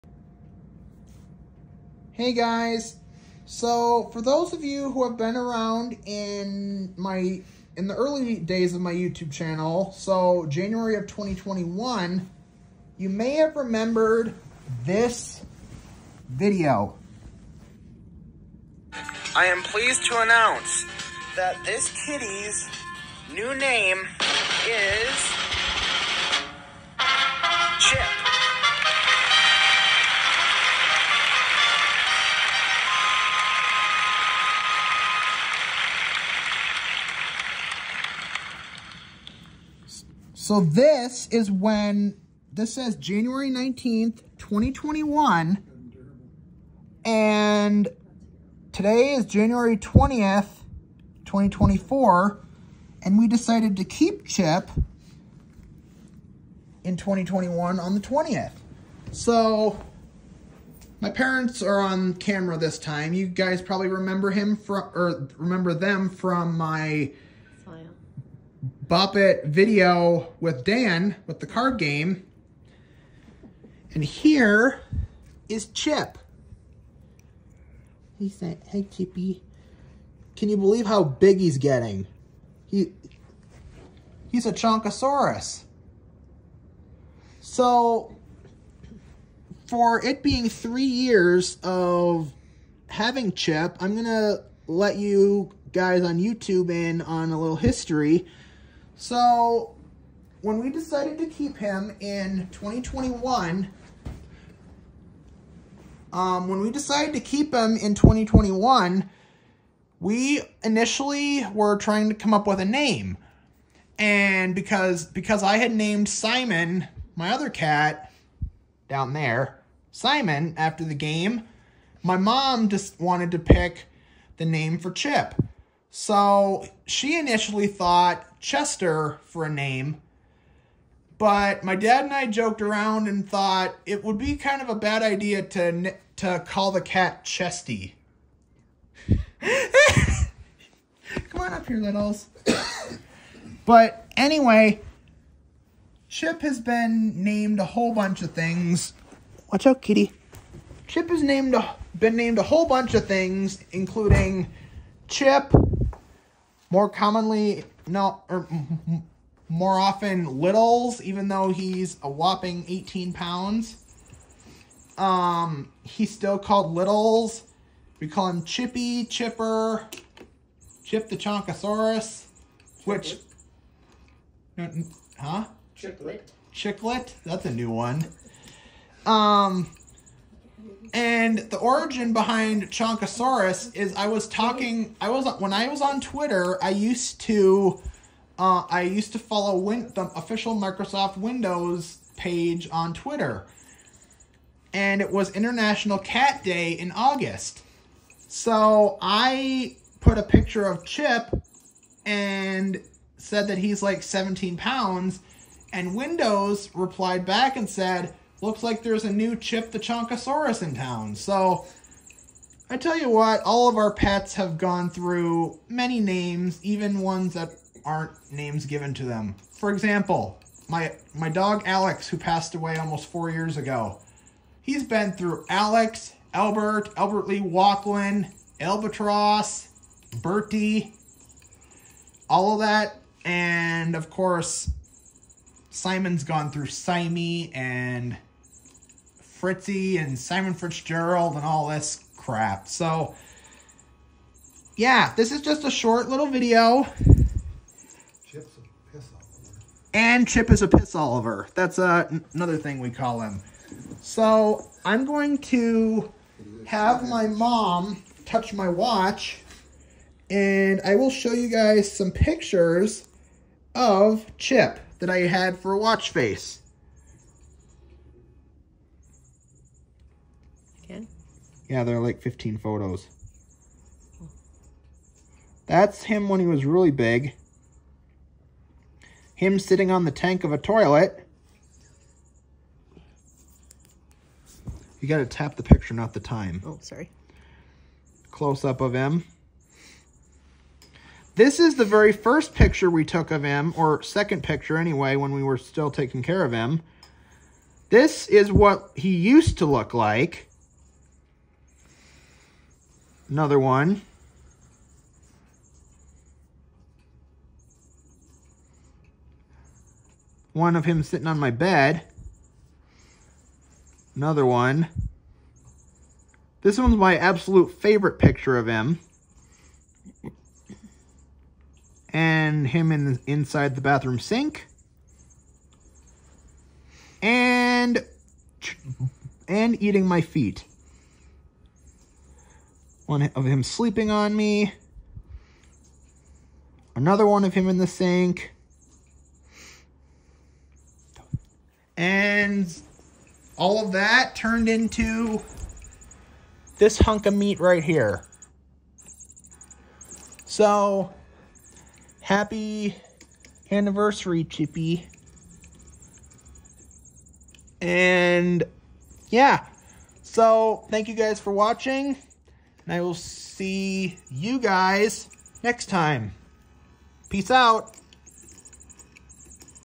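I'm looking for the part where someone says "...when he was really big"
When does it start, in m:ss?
4:36.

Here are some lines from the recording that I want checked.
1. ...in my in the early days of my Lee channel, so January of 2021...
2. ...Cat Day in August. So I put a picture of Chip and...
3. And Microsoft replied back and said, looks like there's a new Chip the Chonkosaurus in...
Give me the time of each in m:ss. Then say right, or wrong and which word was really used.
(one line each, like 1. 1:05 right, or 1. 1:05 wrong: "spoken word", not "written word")
1. 0:06 wrong: "YouTube", not "Lee"
2. 3:15 right
3. 3:25 wrong: "Windows", not "Microsoft".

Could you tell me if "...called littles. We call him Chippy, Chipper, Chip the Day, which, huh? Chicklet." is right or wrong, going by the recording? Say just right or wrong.
wrong.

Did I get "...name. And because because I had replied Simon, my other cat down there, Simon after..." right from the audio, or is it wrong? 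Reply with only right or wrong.
wrong.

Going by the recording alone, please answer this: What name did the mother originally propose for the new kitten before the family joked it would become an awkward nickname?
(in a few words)
Chester.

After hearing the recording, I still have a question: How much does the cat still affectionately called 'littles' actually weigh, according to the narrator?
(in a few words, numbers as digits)
18 pounds.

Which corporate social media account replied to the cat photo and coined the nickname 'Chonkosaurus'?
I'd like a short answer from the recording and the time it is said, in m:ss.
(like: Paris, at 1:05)
Microsoft Windows, at 3:10.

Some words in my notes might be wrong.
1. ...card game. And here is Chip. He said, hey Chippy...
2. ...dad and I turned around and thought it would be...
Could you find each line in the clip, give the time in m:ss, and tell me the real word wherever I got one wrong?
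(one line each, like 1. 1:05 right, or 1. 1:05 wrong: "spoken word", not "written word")
1. 1:11 right
2. 2:11 wrong: "joked", not "turned".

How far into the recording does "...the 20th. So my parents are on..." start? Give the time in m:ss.
0:57.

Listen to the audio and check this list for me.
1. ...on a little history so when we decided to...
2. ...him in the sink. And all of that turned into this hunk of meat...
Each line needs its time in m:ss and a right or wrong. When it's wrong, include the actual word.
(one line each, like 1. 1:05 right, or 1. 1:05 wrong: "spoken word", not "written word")
1. 1:37 right
2. 5:37 right.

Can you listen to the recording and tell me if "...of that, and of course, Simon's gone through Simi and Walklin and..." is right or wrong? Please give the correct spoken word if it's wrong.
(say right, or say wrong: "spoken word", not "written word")
wrong: "Fritzy", not "Walklin".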